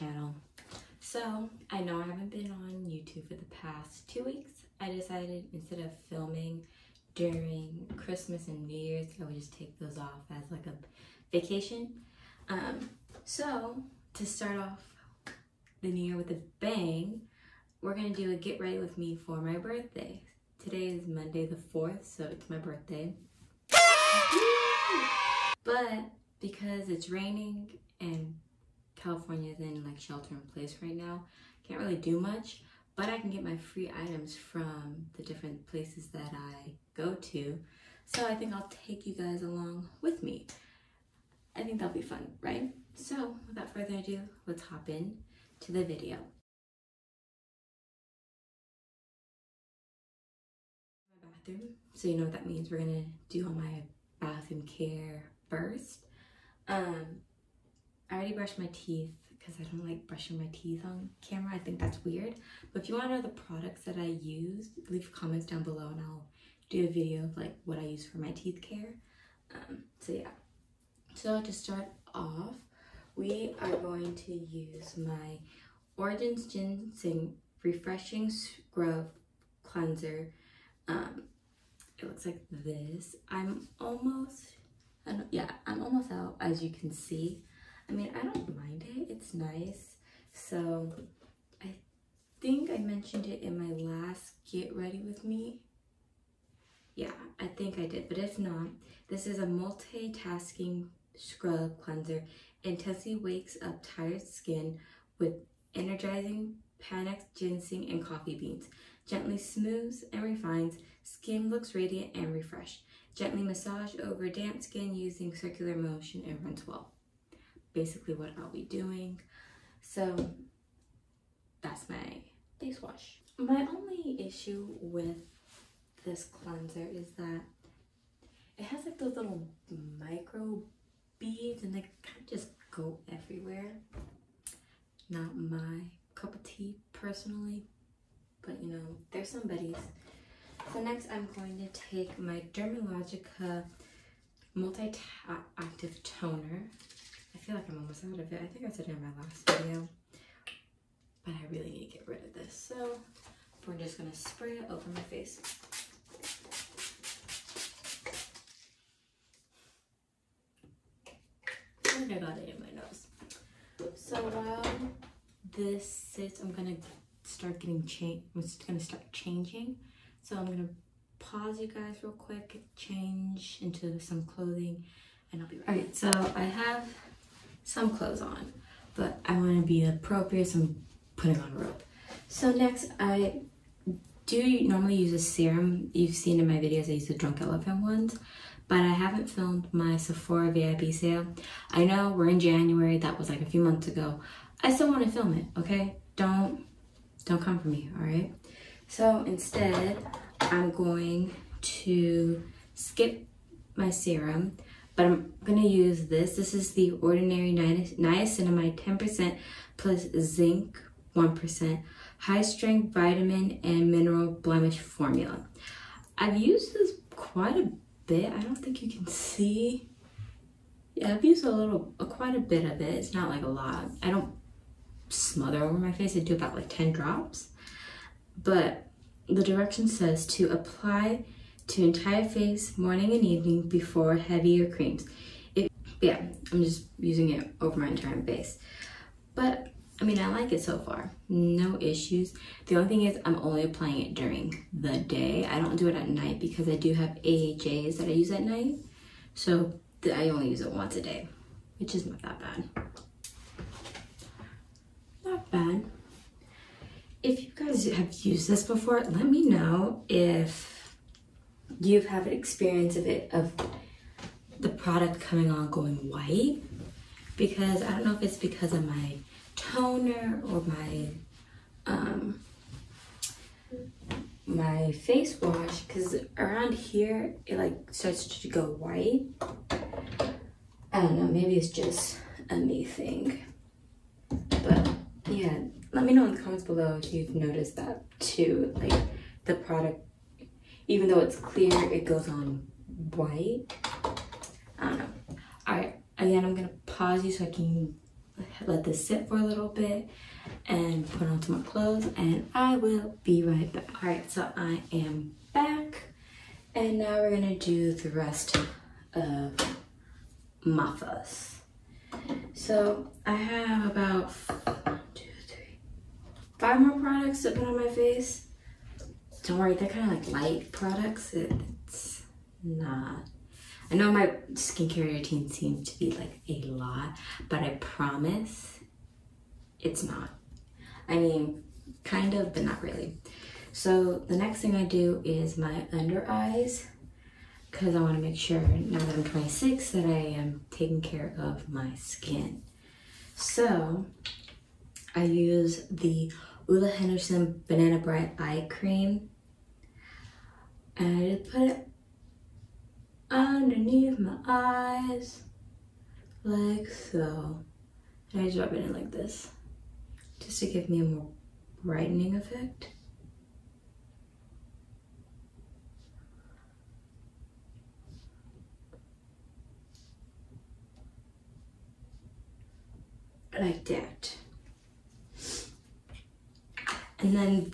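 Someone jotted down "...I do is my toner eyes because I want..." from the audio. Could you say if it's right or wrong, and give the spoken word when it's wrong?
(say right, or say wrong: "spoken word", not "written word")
wrong: "under", not "toner".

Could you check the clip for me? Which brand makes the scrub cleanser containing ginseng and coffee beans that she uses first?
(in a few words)
Origins.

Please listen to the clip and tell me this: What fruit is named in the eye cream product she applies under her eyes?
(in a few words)
Banana.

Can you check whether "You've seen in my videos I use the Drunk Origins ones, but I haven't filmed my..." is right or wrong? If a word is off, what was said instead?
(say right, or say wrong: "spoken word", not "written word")
wrong: "Elephant", not "Origins".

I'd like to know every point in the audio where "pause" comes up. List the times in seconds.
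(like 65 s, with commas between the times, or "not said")
171 s, 296 s.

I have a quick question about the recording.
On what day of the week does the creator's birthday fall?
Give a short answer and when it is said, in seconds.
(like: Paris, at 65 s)
Monday, at 21 s.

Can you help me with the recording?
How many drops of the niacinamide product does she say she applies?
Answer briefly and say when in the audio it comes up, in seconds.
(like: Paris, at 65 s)
10, at 226 s.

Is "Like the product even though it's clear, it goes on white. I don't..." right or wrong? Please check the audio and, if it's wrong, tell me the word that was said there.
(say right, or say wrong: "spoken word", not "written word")
right.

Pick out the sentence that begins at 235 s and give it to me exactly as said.
It, yeah, I'm just using it over my entire face.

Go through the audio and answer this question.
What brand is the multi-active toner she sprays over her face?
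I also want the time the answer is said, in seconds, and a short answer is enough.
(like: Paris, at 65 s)
Dermalogica, at 142 s.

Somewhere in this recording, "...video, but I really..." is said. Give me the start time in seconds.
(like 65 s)
149 s.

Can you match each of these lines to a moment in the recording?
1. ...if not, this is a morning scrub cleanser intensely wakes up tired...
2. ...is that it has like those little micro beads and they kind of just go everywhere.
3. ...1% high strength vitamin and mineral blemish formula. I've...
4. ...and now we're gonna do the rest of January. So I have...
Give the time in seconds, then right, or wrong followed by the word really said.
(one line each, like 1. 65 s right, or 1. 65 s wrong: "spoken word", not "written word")
1. 98 s wrong: "multitasking", not "morning"
2. 126 s right
3. 211 s right
4. 306 s wrong: "Mafas", not "January".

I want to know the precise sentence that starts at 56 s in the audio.
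Um, I already brushed my teeth because I don't like brushing my teeth on camera.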